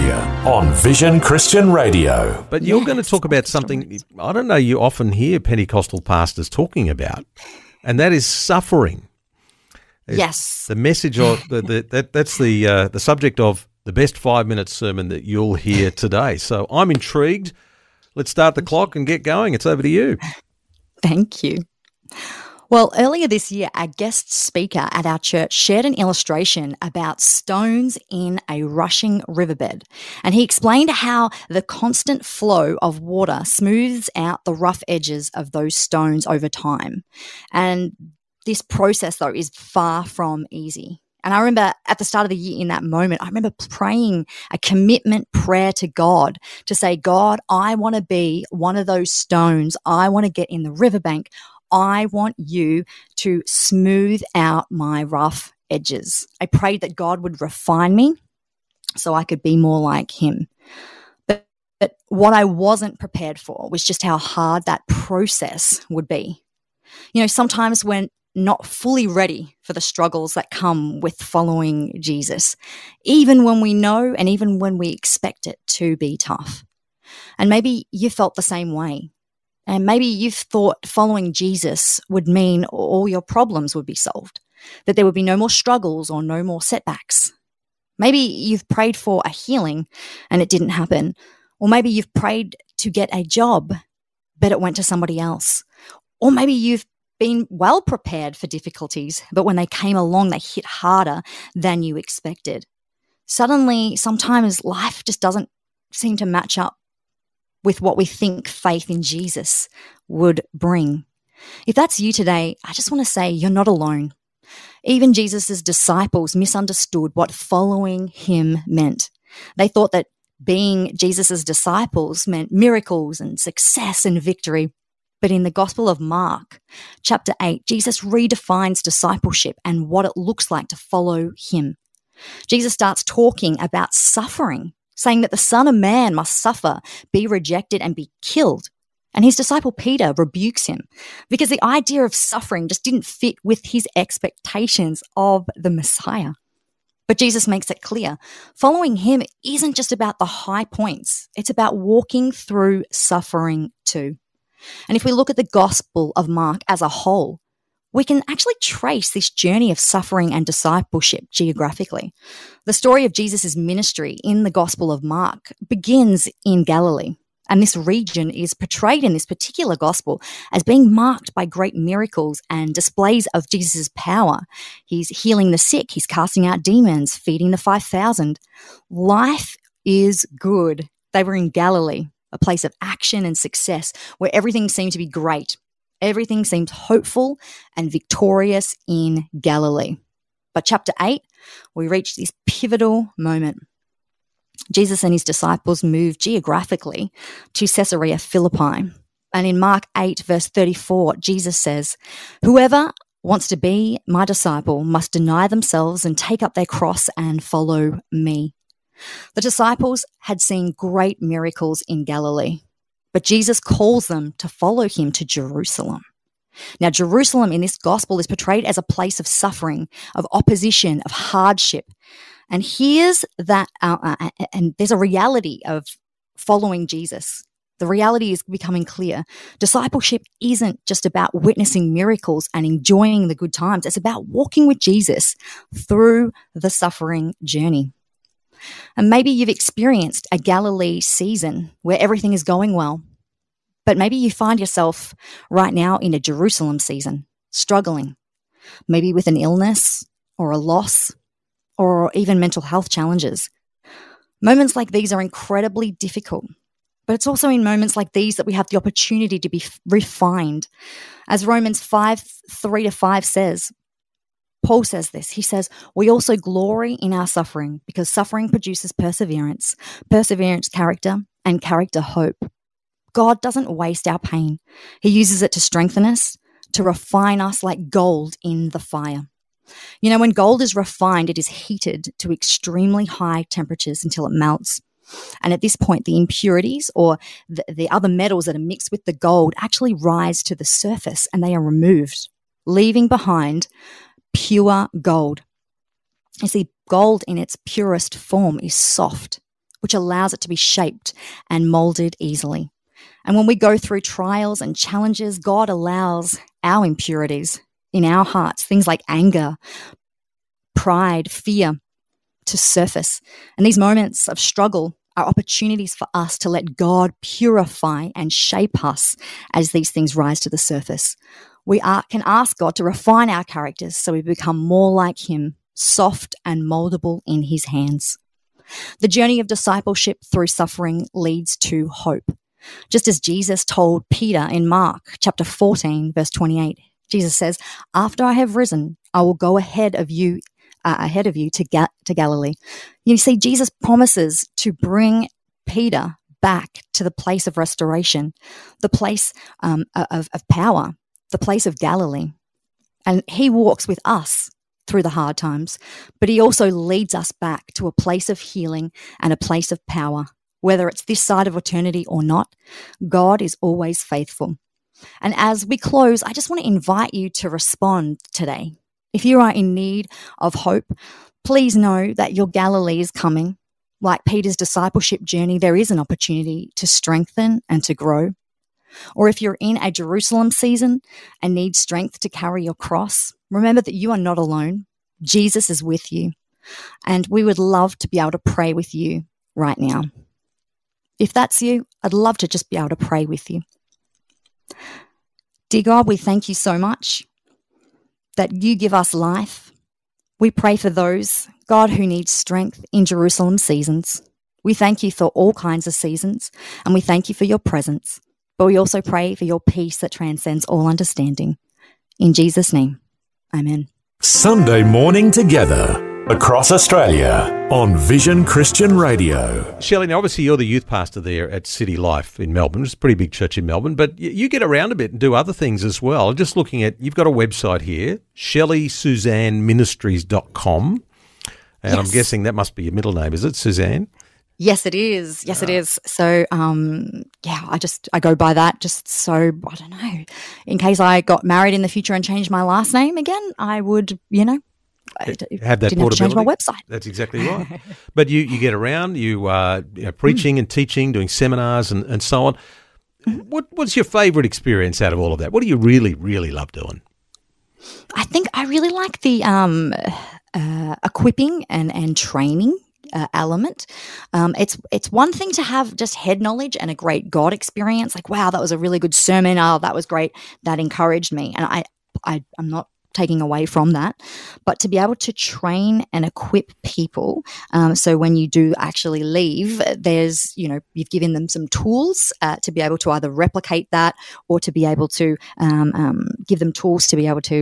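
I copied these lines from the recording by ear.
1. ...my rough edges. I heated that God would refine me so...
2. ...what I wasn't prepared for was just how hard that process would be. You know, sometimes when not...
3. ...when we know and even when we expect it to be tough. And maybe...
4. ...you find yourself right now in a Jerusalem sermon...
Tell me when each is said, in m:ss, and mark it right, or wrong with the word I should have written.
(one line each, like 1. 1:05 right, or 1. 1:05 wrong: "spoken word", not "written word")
1. 0:54 wrong: "prayed", not "heated"
2. 1:02 right
3. 1:13 right
4. 4:04 wrong: "season", not "sermon".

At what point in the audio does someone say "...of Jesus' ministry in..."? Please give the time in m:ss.
2:43.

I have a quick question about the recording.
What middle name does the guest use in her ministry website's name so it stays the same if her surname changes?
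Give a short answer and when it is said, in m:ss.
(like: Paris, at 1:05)
Susanne, at 7:13.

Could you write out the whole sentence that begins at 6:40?
We pray for those, God, who need strength in Jerusalem seasons.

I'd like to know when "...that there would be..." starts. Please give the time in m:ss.
1:24.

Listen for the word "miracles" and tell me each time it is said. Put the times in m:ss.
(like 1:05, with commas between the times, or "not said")
2:02, 2:51, 3:31, 3:51.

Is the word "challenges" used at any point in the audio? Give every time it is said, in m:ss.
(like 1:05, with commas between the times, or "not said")
4:12, 5:04.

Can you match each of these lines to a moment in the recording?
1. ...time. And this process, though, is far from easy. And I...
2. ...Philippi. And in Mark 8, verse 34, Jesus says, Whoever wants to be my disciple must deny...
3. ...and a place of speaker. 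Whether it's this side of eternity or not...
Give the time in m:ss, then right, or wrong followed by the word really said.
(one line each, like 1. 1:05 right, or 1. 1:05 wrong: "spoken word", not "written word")
1. 0:36 right
2. 3:18 right
3. 5:59 wrong: "power", not "speaker".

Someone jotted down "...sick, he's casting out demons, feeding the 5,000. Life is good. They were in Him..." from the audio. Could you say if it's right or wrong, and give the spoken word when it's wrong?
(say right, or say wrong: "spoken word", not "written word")
wrong: "Galilee", not "Him".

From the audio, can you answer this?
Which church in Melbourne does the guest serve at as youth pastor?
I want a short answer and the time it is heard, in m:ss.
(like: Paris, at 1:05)
City Life, at 7:01.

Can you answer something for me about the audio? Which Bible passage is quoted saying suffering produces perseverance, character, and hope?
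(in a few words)
Romans 5:3-5.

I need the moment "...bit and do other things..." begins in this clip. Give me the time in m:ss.
7:04.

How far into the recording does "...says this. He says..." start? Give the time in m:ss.
4:24.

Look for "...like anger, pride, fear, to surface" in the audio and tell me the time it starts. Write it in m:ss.
5:08.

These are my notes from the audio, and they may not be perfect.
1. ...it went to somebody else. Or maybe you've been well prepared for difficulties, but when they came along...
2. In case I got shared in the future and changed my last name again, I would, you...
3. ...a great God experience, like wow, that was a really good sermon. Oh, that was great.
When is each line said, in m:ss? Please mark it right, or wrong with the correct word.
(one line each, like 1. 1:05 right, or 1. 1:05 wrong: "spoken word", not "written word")
1. 1:34 right
2. 7:20 wrong: "married", not "shared"
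3. 7:46 right.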